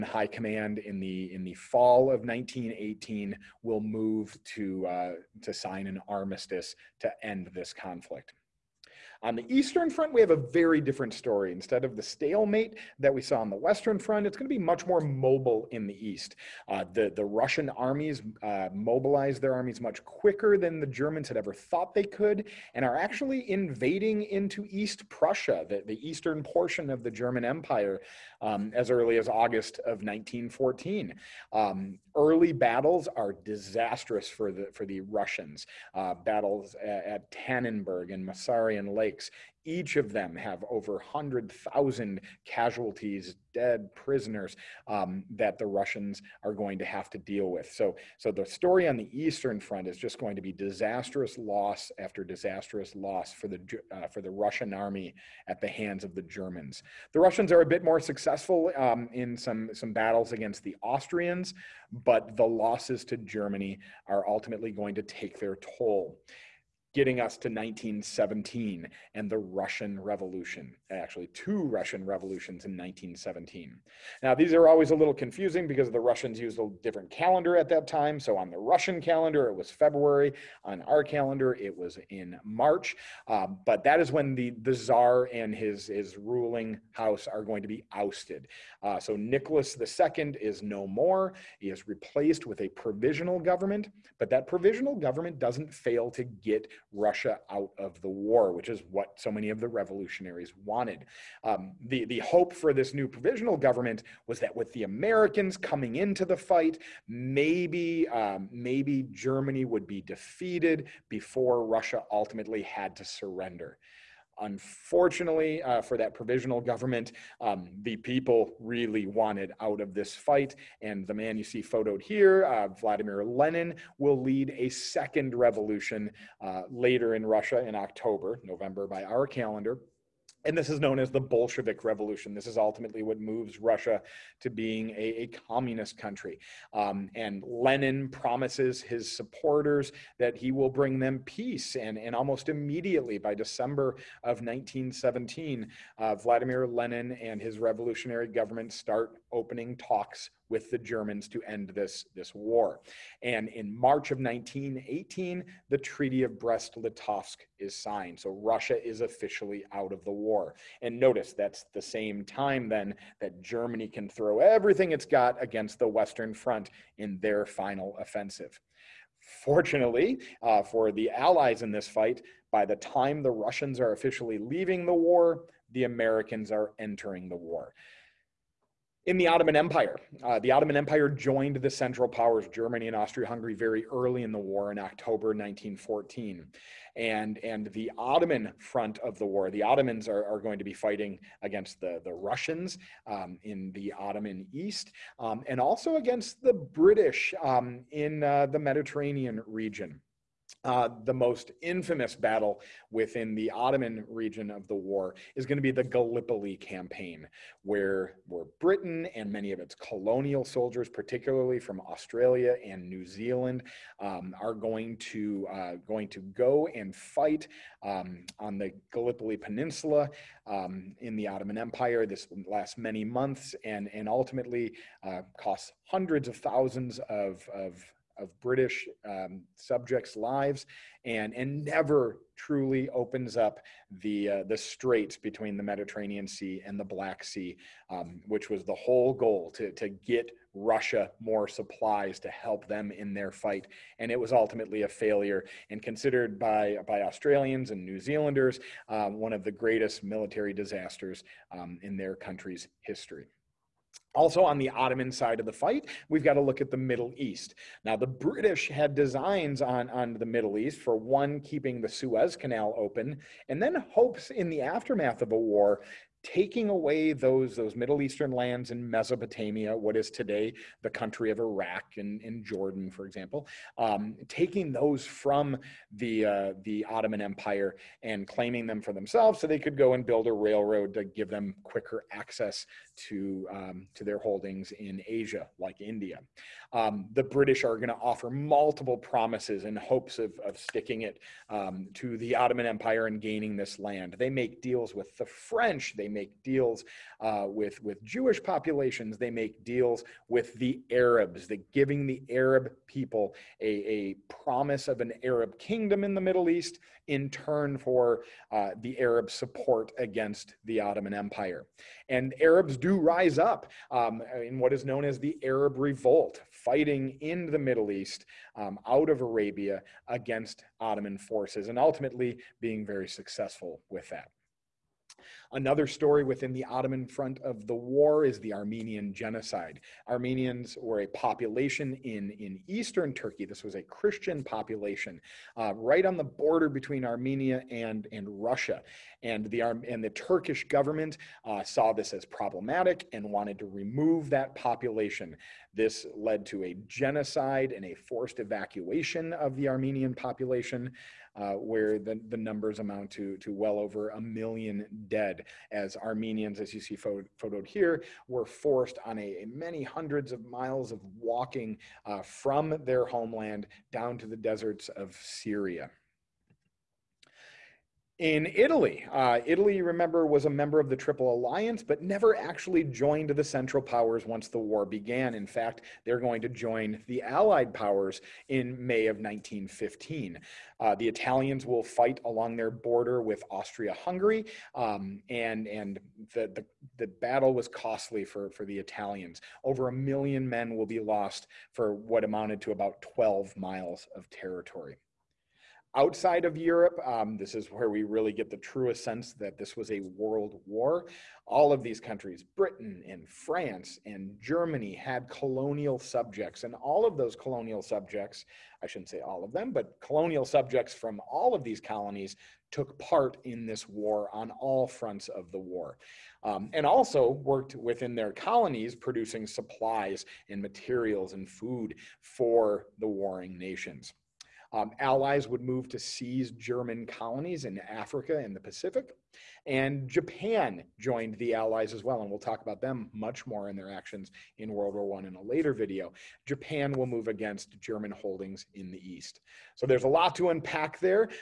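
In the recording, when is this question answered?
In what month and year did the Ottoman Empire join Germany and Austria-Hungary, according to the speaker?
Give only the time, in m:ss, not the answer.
3:04.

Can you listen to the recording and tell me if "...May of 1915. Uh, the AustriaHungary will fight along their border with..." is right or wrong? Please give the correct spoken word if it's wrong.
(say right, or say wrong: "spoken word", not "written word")
wrong: "Italians", not "AustriaHungary".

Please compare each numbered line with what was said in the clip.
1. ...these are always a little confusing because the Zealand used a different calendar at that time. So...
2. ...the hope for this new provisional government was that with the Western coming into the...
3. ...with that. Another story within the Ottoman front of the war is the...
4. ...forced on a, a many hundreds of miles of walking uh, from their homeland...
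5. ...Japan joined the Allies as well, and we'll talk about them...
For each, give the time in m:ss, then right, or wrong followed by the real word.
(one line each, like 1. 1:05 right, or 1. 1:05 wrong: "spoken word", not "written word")
1. 1:14 wrong: "Russians", not "Zealand"
2. 1:42 wrong: "Americans", not "Western"
3. 5:23 right
4. 5:58 right
5. 7:10 right.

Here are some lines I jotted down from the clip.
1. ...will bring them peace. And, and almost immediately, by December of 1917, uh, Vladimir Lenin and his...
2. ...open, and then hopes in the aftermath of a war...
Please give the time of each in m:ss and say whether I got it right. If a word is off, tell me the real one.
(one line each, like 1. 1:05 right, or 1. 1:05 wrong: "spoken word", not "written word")
1. 2:20 right
2. 4:22 right.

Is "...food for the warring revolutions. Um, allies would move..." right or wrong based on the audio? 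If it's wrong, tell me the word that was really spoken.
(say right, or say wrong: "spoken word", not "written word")
wrong: "nations", not "revolutions".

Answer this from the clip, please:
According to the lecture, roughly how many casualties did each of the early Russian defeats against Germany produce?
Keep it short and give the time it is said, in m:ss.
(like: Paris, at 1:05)
Over 100,000, at 0:40.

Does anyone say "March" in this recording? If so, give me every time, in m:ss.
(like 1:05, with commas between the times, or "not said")
1:22, 2:33.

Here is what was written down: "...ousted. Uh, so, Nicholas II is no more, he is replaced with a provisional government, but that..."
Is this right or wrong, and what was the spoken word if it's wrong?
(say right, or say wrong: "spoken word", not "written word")
right.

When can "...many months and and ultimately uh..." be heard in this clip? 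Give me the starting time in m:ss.
3:42.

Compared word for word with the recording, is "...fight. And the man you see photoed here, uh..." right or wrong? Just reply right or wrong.
right.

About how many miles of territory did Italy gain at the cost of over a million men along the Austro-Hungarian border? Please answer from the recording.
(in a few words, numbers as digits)
12 miles.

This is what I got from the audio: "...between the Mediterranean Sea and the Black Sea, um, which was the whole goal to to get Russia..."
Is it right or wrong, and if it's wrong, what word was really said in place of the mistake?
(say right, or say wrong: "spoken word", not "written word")
right.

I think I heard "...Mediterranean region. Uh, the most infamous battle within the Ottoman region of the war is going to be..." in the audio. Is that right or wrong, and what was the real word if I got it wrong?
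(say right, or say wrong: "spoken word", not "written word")
right.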